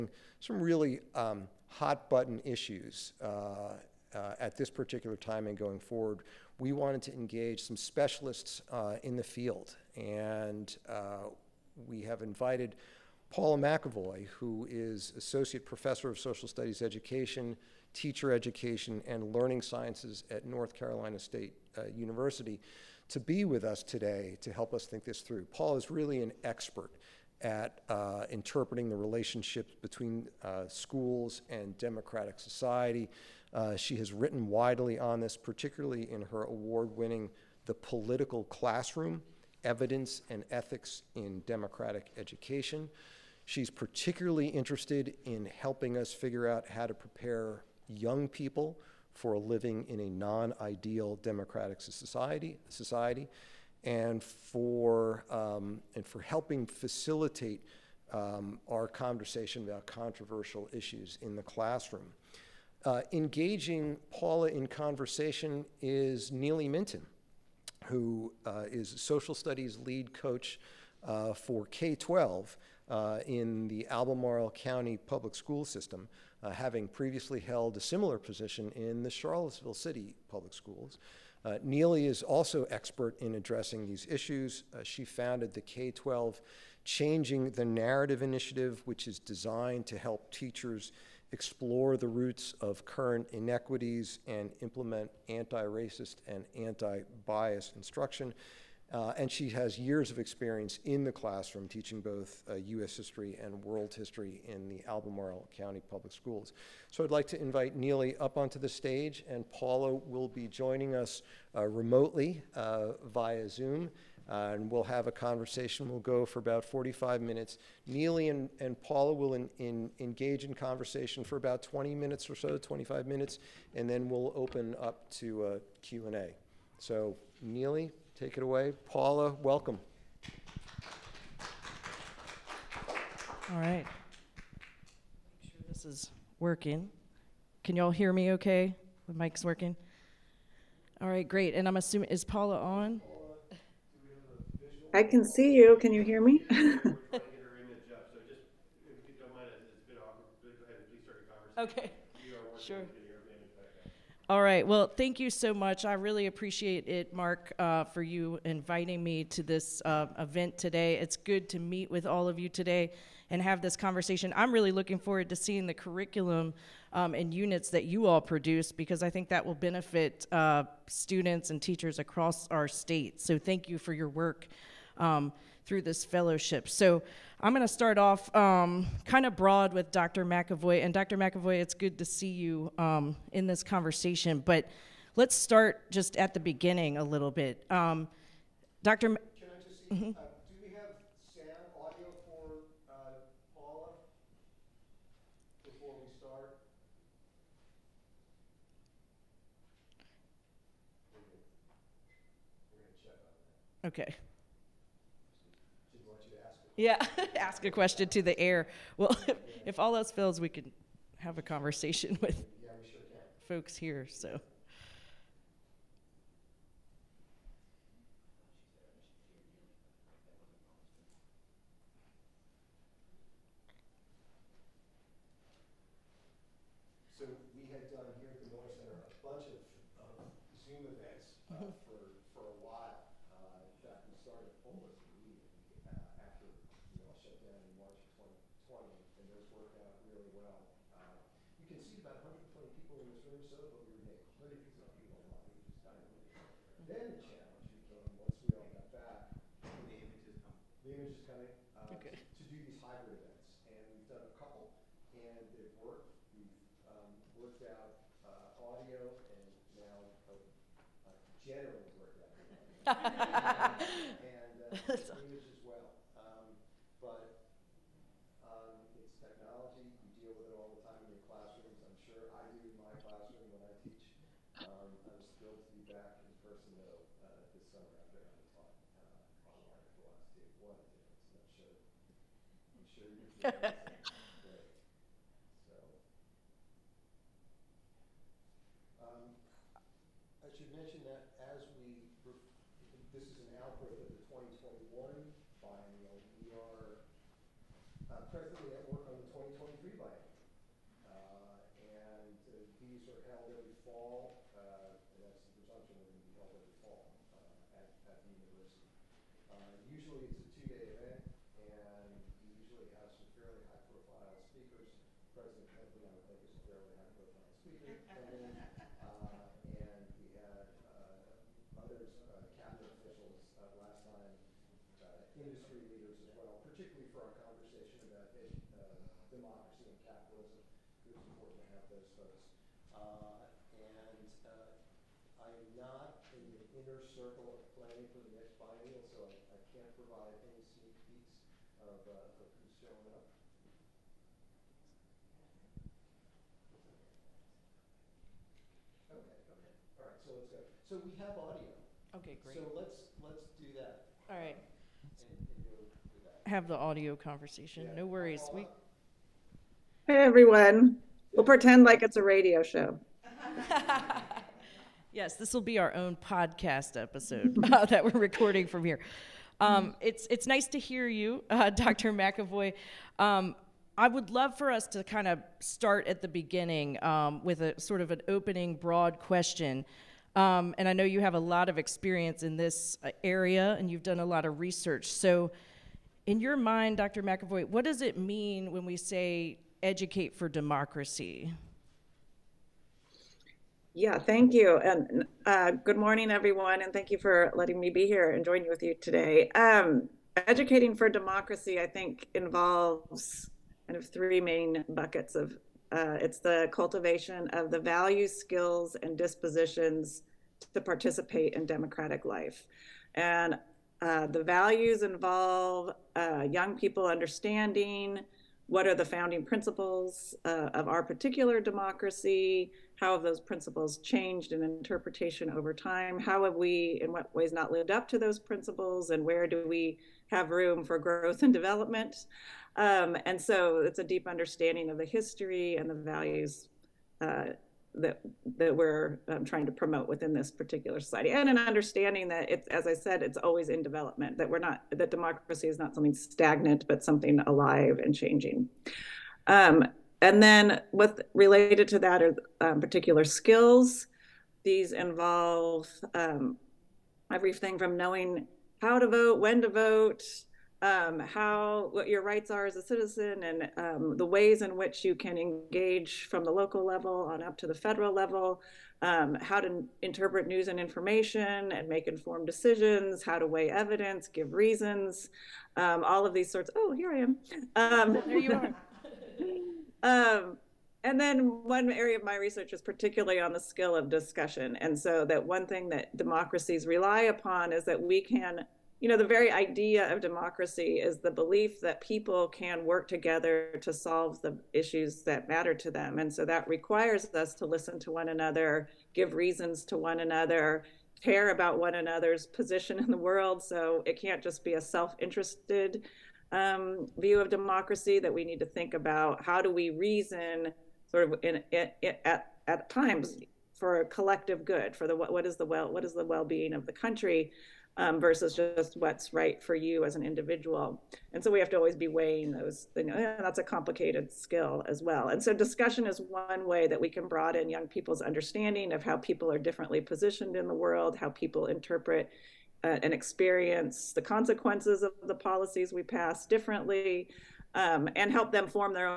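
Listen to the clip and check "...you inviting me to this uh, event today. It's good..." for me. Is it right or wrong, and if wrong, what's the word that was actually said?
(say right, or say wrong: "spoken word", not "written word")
right.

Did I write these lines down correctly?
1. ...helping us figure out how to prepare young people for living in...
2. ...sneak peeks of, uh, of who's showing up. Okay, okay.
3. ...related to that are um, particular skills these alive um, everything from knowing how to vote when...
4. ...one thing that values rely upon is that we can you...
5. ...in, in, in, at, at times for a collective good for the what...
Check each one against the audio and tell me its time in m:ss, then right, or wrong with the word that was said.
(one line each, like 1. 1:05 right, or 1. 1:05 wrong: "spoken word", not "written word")
1. 0:45 right
2. 5:40 right
3. 7:31 wrong: "involve", not "alive"
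4. 8:05 wrong: "democracies", not "values"
5. 8:31 right.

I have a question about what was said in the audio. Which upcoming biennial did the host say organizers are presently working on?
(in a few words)
2023.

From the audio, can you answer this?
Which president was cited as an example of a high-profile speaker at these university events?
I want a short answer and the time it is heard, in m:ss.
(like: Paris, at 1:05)
President Kennedy, at 5:15.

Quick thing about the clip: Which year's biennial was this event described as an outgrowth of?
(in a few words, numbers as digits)
2021.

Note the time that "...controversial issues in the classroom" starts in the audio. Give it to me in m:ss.
0:59.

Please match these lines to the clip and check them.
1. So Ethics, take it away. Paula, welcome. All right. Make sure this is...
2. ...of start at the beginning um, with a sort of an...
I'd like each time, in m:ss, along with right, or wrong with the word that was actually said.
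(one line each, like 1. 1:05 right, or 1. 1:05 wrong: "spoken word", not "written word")
1. 2:06 wrong: "Neely", not "Ethics"
2. 6:15 right.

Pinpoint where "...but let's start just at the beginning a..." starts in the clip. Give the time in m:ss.
3:04.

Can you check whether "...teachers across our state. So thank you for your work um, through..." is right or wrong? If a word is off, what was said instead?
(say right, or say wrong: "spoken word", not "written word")
right.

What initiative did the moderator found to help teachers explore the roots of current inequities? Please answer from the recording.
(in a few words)
Changing the Narrative.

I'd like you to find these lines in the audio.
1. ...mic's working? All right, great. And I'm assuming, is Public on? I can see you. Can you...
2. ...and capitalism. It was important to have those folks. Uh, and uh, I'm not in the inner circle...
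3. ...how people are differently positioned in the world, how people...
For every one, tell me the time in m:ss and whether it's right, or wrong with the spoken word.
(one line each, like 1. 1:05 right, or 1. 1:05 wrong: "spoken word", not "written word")
1. 2:19 wrong: "Paula", not "Public"
2. 5:29 right
3. 8:49 right.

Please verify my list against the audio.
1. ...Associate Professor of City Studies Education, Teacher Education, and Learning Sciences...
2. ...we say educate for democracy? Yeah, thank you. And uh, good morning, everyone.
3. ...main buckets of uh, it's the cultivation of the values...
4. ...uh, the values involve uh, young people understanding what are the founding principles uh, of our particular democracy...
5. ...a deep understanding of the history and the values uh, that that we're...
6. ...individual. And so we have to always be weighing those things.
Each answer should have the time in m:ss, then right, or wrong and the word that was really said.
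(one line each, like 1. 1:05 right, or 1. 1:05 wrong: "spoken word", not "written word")
1. 0:15 wrong: "Social", not "City"
2. 6:28 right
3. 6:44 right
4. 6:54 right
5. 7:13 right
6. 8:40 right.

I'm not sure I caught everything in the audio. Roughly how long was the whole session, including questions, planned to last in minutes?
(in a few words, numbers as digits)
45.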